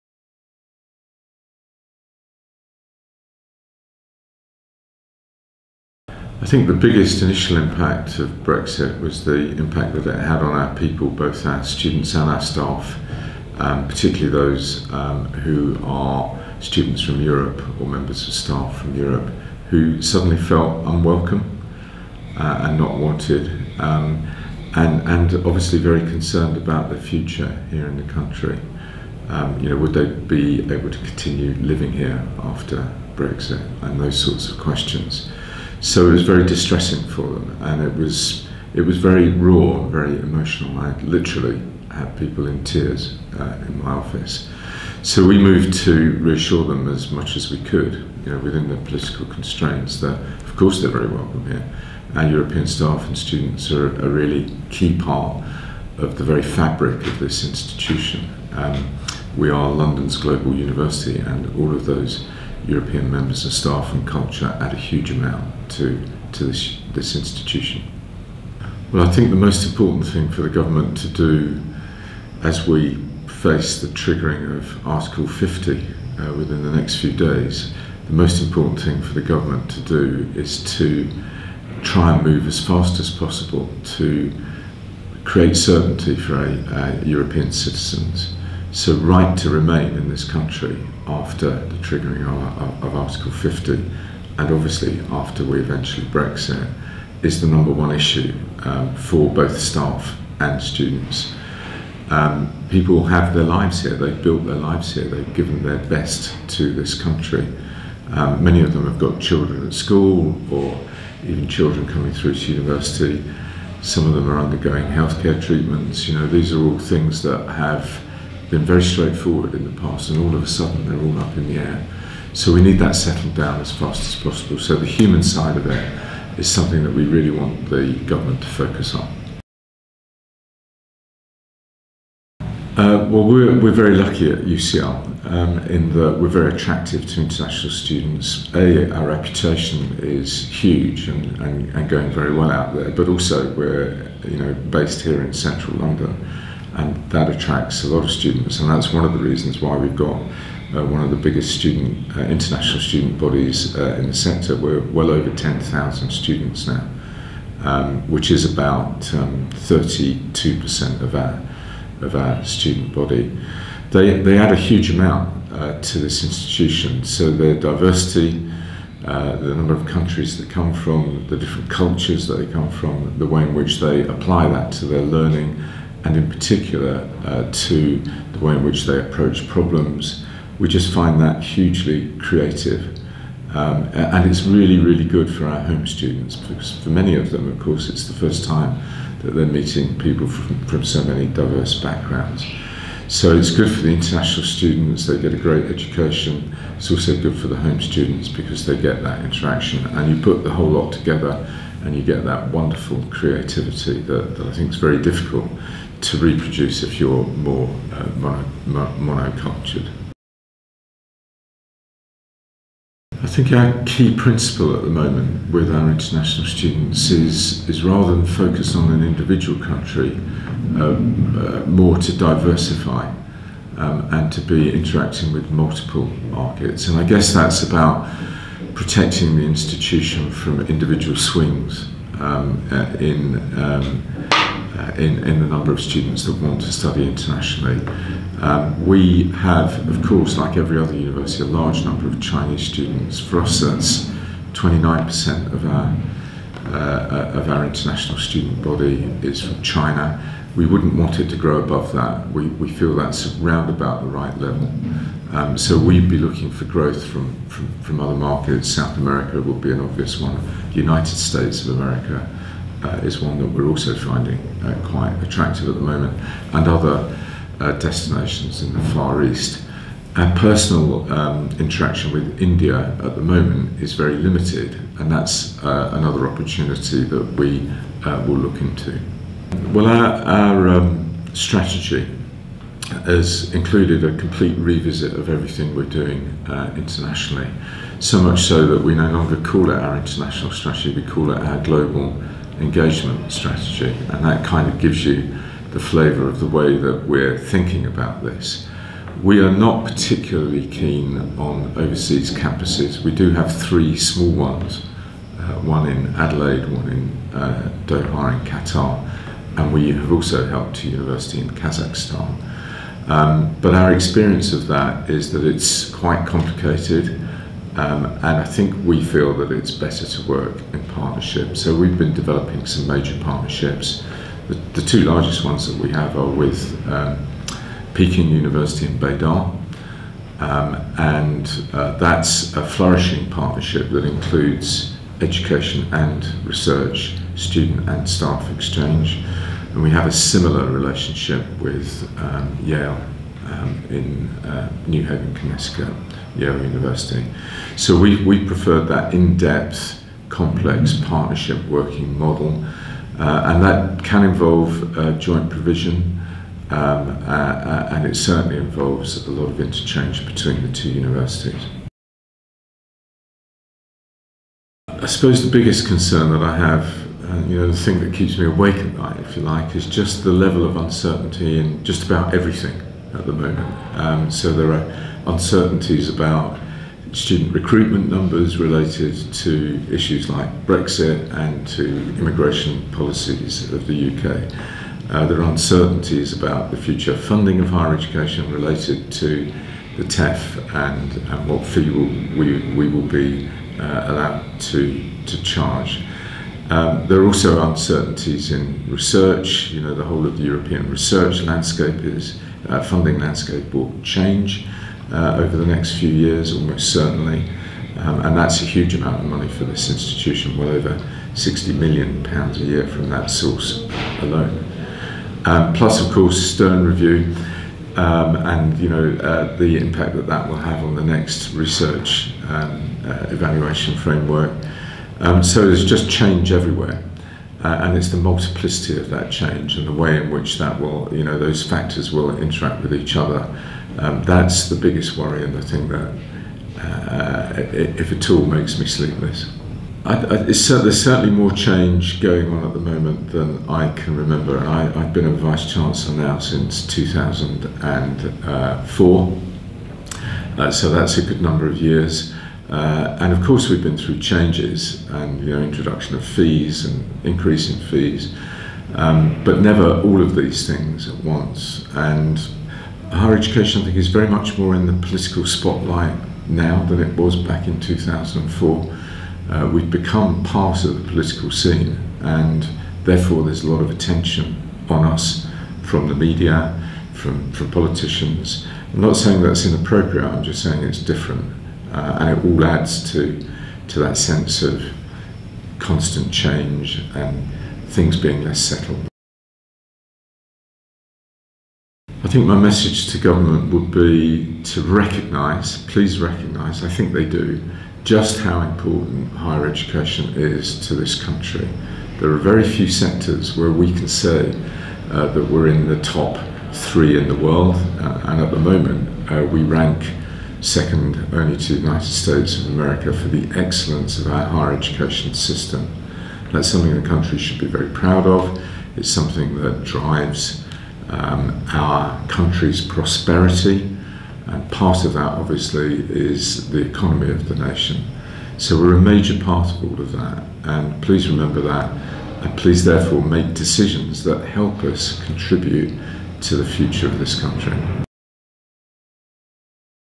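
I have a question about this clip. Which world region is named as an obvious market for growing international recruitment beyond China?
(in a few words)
South America.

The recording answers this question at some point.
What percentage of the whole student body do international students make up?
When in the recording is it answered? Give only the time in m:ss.
2:39.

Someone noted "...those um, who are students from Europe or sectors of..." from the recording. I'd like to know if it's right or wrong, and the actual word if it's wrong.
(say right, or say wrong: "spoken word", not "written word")
wrong: "members", not "sectors".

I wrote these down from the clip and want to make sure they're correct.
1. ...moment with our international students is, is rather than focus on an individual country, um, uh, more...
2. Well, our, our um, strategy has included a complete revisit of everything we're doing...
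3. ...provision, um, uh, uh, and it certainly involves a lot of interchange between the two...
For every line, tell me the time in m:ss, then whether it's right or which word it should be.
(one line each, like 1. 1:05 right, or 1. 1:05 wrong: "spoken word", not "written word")
1. 3:34 right
2. 4:39 right
3. 5:55 right.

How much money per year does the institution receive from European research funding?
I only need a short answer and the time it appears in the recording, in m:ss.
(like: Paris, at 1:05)
over 60 million pounds, at 6:50.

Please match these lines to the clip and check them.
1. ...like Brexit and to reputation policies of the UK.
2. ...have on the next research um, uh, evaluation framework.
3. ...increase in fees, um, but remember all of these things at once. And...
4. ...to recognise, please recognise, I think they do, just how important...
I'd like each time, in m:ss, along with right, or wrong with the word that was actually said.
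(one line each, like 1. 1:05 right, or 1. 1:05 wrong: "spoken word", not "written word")
1. 6:20 wrong: "immigration", not "reputation"
2. 7:00 right
3. 7:37 wrong: "never", not "remember"
4. 8:14 right.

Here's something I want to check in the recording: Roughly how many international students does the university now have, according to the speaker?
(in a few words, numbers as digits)
over 10,000.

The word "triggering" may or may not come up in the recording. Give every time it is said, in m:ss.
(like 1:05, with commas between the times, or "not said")
1:13, 1:31.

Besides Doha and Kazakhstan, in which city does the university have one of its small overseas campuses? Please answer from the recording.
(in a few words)
Adelaide.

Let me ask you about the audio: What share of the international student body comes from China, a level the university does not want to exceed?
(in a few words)
29%.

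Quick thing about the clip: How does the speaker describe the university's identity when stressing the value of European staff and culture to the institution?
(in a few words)
London's global university.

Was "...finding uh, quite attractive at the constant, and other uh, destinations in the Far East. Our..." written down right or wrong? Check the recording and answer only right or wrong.
wrong.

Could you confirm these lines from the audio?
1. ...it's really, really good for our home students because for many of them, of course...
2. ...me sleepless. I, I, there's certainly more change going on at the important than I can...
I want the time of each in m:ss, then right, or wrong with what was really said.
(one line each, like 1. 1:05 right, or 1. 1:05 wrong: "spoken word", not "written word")
1. 3:04 right
2. 7:18 wrong: "moment", not "important".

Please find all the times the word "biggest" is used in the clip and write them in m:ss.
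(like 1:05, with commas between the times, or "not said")
0:06, 2:31, 6:05, 7:14.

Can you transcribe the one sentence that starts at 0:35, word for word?
So it was very distressing for them, and it was it was very raw, very emotional.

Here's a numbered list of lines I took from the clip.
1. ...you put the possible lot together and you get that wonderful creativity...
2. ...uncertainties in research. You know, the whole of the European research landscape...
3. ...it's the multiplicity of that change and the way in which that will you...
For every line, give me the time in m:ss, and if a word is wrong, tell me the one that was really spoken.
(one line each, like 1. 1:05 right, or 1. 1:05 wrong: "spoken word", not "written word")
1. 3:20 wrong: "whole", not "possible"
2. 6:37 right
3. 7:07 right.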